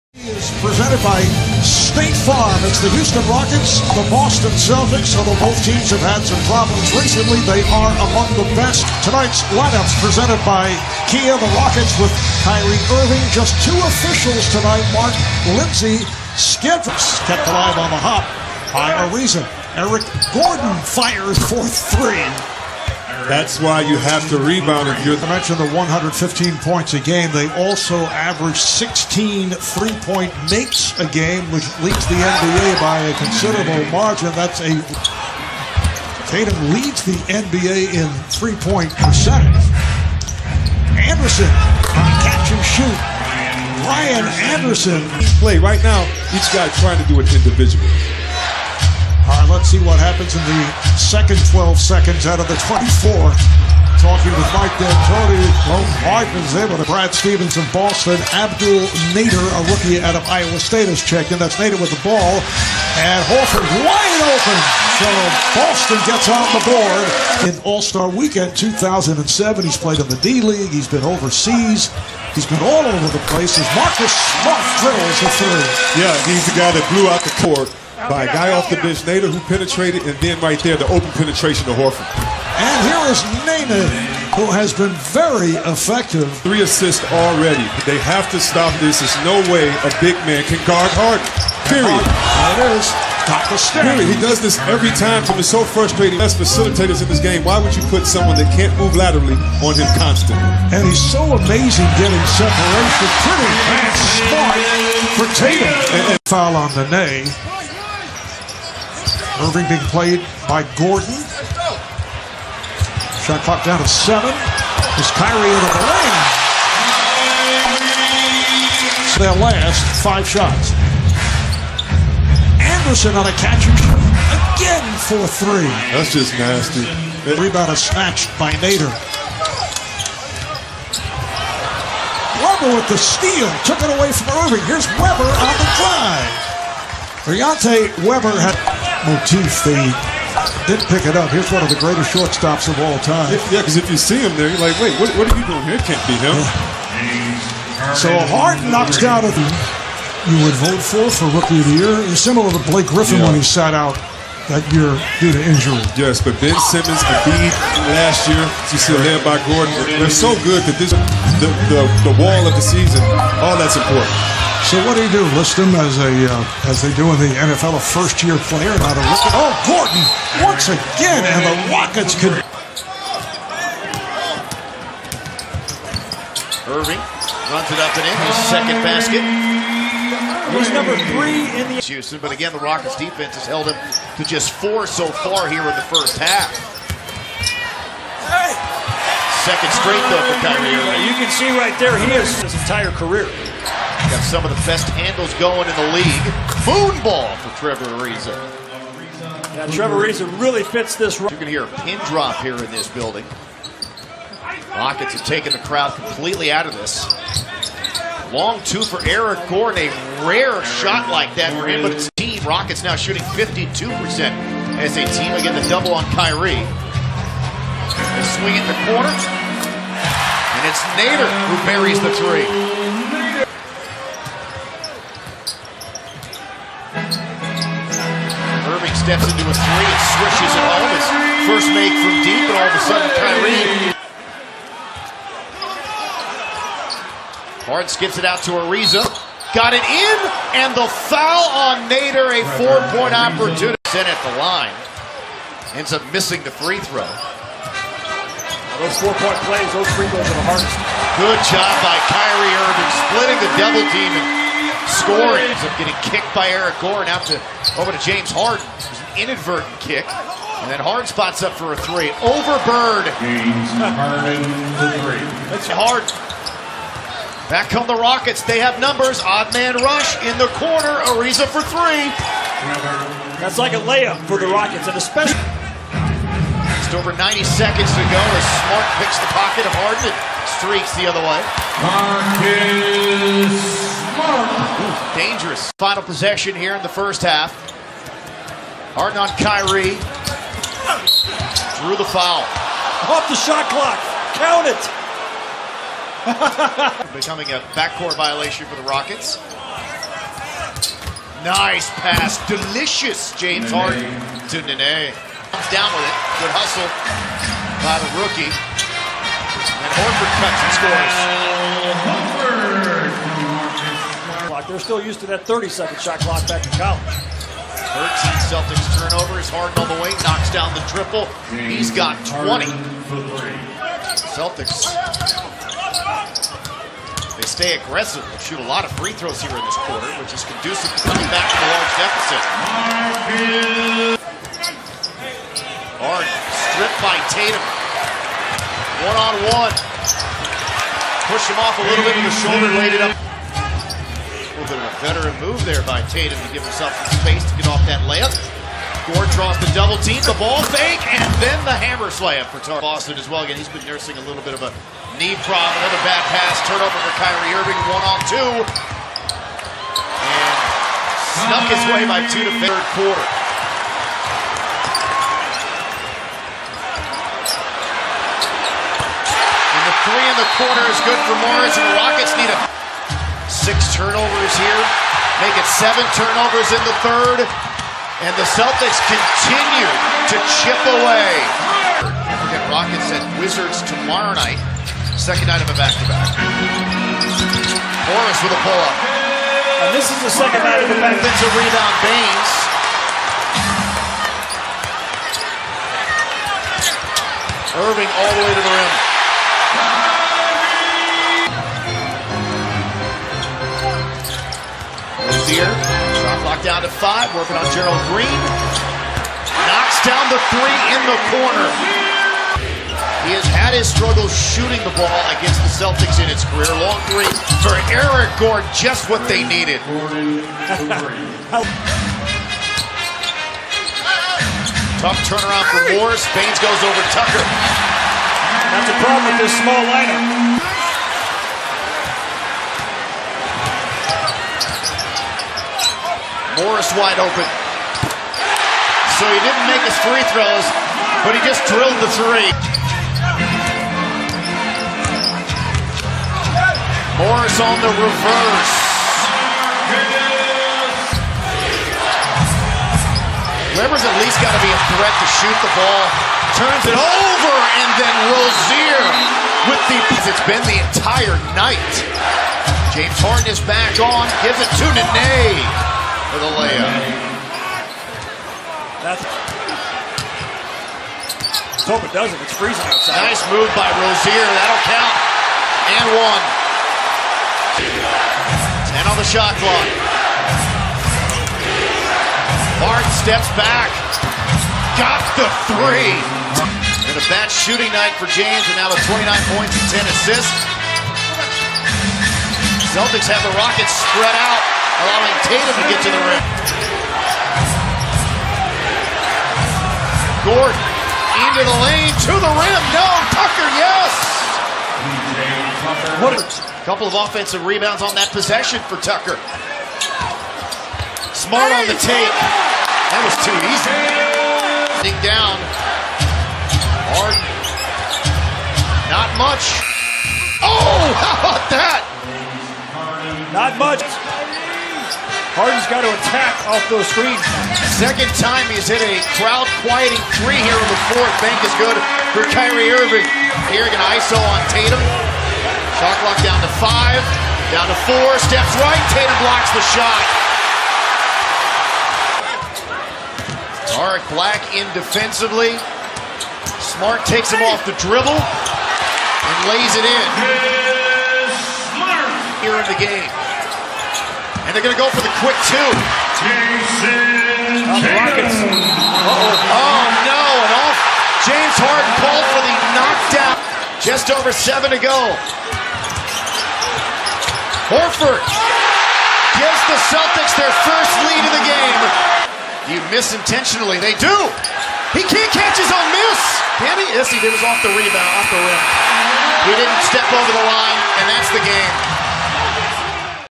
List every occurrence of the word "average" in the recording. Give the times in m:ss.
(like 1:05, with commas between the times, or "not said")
0:28.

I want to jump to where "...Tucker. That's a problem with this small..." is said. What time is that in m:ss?
7:07.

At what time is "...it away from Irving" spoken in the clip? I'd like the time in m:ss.
2:13.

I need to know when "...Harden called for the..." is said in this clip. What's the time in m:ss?
9:21.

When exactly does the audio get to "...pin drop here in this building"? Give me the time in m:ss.
3:21.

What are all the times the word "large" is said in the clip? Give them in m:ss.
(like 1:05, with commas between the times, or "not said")
5:31.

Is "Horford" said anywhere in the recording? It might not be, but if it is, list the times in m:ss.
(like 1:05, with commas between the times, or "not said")
1:03, 1:21, 5:10, 9:27.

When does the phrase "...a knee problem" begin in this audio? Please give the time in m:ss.
5:54.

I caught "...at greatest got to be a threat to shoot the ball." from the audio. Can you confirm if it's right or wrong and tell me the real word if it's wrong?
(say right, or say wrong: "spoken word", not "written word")
wrong: "least", not "greatest".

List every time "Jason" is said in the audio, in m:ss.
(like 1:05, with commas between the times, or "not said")
9:16.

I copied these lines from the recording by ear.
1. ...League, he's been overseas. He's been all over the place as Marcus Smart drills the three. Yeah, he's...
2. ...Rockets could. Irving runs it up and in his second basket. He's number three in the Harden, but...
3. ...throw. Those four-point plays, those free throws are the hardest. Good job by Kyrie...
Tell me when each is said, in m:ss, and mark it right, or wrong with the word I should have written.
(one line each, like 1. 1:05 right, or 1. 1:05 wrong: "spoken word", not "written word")
1. 1:10 right
2. 2:51 wrong: "Houston", not "Harden"
3. 4:06 right.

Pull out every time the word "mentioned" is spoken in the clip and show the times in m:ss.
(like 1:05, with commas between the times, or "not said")
0:25.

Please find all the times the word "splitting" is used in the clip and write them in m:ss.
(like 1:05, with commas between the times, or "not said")
4:13.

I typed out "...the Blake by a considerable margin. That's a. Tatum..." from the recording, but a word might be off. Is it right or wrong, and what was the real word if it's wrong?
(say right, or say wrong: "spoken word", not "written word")
wrong: "NBA", not "Blake".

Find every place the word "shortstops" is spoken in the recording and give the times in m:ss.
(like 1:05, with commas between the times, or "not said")
2:22.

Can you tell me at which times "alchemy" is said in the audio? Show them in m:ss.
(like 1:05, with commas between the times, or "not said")
not said.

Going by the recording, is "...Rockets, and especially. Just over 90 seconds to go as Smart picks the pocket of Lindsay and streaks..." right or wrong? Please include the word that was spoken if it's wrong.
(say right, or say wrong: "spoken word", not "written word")
wrong: "Harden", not "Lindsay".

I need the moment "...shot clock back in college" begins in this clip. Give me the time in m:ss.
5:15.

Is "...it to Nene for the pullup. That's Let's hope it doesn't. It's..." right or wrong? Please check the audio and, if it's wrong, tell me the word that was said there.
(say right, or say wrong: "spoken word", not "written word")
wrong: "layup", not "pullup".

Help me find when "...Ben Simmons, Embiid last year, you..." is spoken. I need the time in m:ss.
2:36.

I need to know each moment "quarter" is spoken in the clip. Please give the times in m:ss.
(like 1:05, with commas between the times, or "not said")
5:29, 6:02.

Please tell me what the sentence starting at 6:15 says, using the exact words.
Make it seven turnovers in the third.